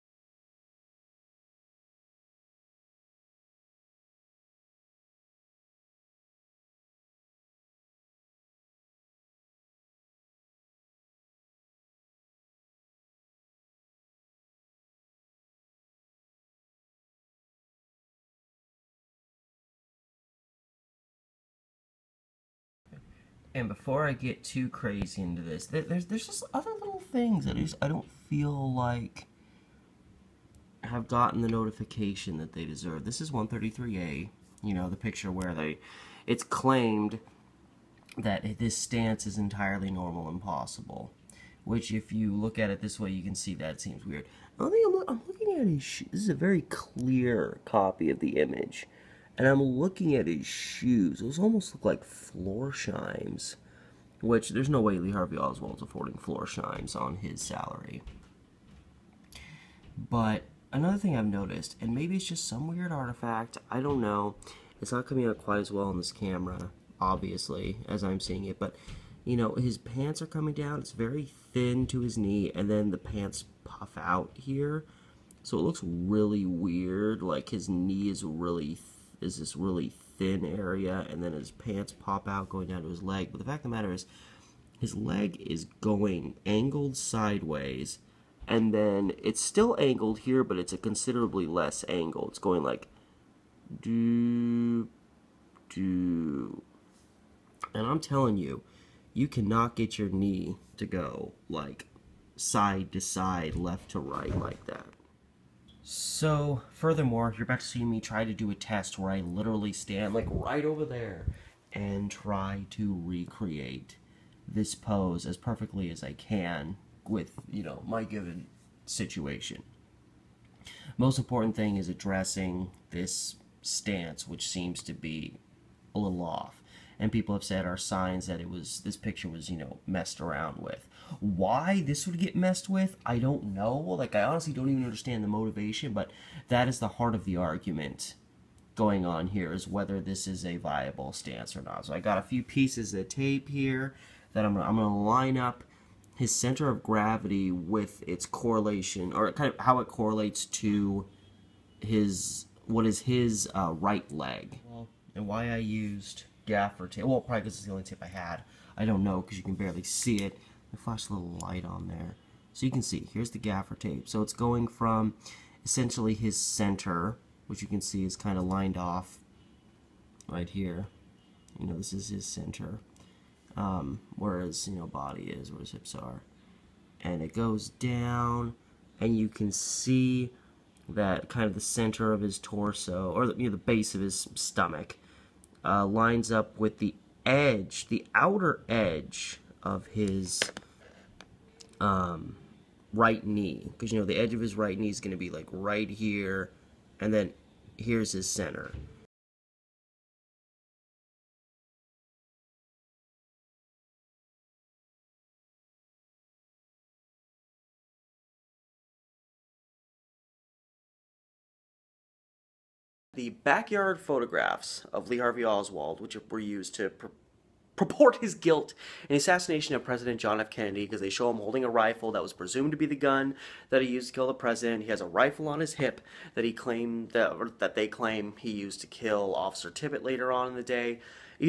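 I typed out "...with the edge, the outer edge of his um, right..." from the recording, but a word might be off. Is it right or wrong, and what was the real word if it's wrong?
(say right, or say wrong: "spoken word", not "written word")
right.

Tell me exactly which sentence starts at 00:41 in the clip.
Which, if you look at it this way, you can see that seems weird.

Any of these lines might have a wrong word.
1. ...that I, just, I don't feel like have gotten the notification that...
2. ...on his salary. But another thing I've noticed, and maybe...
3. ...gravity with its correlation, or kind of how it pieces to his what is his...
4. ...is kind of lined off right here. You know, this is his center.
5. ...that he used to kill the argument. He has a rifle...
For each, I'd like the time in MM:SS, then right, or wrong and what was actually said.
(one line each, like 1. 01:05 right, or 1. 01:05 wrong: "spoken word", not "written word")
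1. 00:27 right
2. 00:56 right
3. 02:26 wrong: "correlates", not "pieces"
4. 02:48 right
5. 03:43 wrong: "president", not "argument".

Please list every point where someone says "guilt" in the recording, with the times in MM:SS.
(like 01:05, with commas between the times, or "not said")
03:38.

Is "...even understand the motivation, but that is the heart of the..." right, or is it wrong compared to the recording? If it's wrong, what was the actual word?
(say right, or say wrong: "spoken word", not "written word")
right.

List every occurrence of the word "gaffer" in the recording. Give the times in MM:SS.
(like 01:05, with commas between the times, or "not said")
02:36, 02:43.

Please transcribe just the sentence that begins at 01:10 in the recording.
It's very thin to his knee, and then the pants puff out here.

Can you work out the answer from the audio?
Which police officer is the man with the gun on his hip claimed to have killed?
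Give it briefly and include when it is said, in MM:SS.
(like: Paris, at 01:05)
Officer Tippit, at 03:49.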